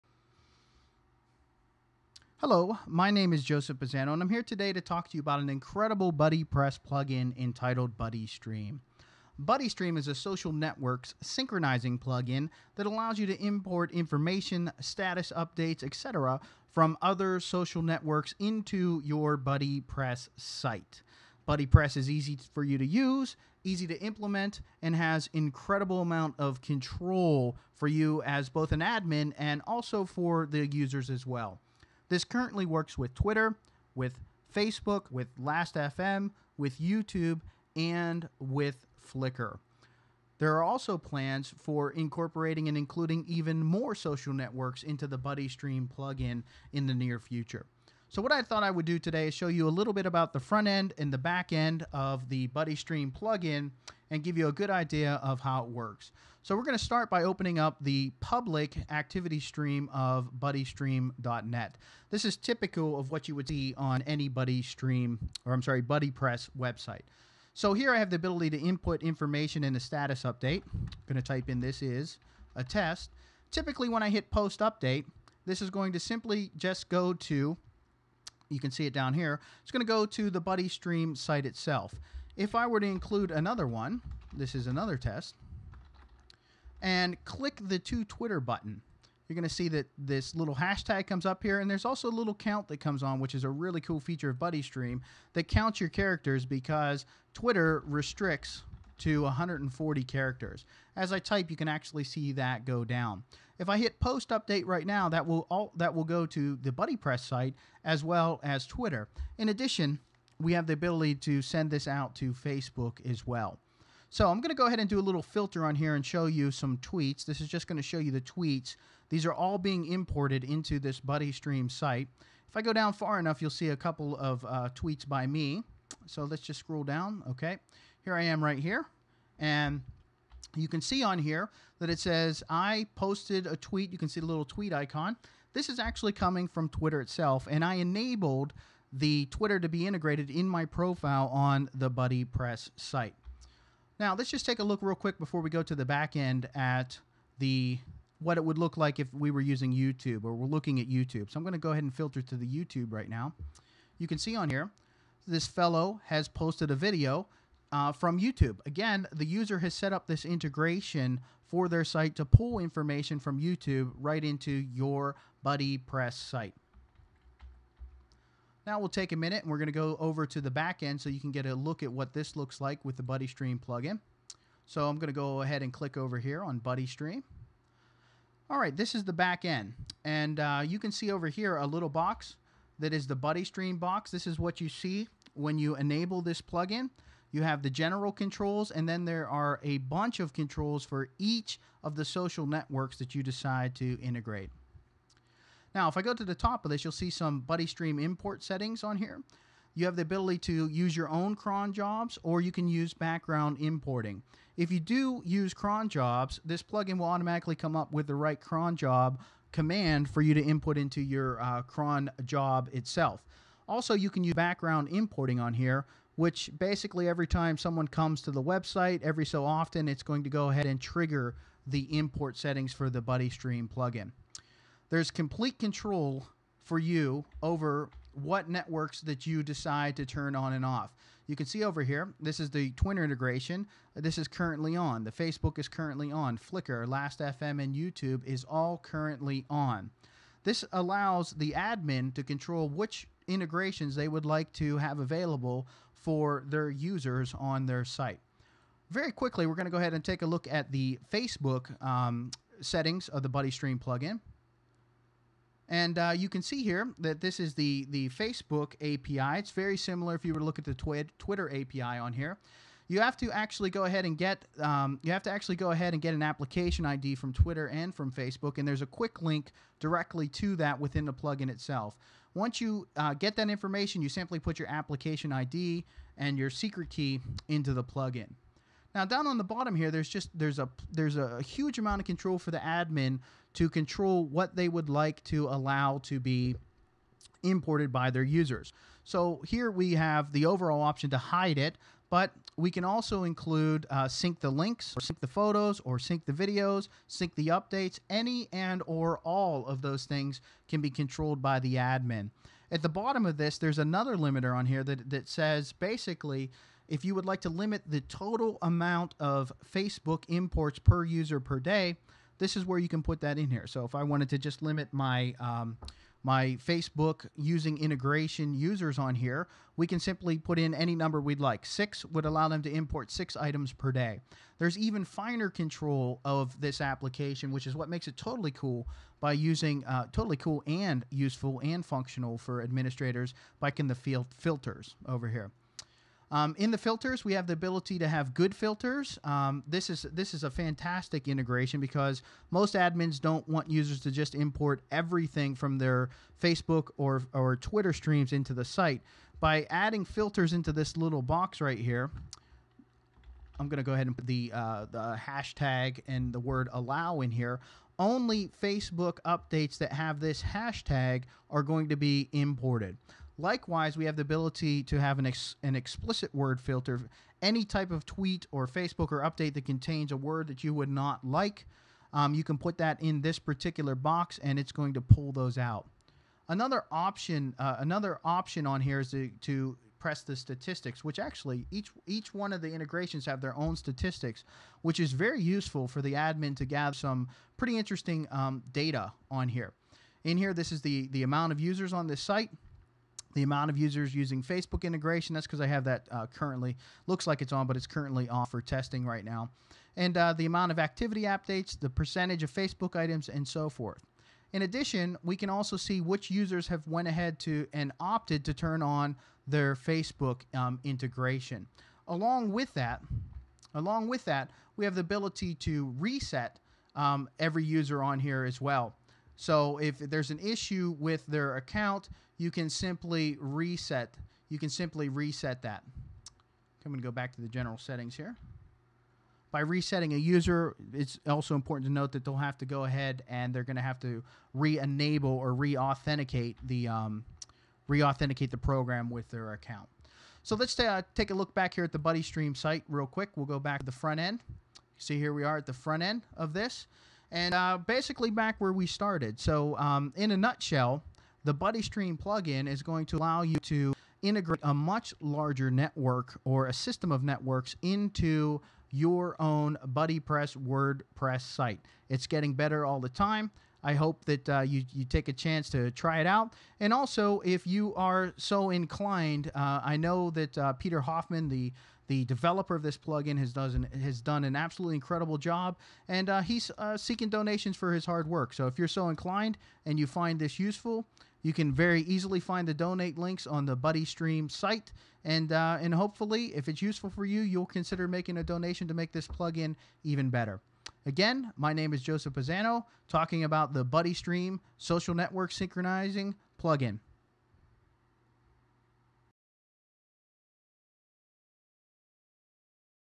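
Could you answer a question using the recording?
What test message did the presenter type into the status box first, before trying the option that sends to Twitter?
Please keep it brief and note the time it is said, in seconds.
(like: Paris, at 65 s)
This is a test, at 71 s.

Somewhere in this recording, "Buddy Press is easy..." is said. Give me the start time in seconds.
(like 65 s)
21 s.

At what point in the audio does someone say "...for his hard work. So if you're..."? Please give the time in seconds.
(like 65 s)
477 s.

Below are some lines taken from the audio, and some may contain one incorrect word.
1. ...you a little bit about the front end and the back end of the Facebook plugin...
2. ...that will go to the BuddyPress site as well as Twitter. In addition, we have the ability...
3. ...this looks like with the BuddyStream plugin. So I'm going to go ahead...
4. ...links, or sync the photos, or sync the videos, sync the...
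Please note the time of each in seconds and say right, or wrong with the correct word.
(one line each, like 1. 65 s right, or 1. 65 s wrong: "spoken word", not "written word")
1. 49 s wrong: "BuddyStream", not "Facebook"
2. 105 s right
3. 172 s right
4. 294 s right.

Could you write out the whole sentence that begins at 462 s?
It's getting better all the time.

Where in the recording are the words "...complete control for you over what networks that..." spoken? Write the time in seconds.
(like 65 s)
225 s.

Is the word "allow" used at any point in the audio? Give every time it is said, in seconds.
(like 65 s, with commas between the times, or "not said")
12 s, 240 s, 285 s, 322 s, 356 s, 453 s.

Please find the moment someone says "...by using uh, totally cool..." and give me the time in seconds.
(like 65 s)
329 s.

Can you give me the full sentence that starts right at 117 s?
This is just going to show you the tweets.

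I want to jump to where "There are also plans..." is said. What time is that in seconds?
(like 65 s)
40 s.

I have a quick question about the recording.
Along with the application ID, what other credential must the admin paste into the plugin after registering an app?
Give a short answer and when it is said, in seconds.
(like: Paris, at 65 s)
Secret key, at 276 s.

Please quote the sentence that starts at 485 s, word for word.
And, uh, and hopefully, if it's useful for you, you'll consider making a donation to make this plugin even better.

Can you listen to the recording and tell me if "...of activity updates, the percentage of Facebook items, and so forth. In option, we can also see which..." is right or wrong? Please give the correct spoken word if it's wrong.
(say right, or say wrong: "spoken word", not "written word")
wrong: "addition", not "option".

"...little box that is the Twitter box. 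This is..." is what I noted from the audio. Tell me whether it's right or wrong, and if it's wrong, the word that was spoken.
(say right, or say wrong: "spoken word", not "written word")
wrong: "BuddyStream", not "Twitter".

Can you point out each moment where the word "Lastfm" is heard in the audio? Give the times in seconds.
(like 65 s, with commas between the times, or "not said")
35 s, 236 s.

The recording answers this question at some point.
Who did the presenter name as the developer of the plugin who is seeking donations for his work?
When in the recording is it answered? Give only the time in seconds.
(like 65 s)
470 s.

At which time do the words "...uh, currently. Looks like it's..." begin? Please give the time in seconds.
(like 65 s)
396 s.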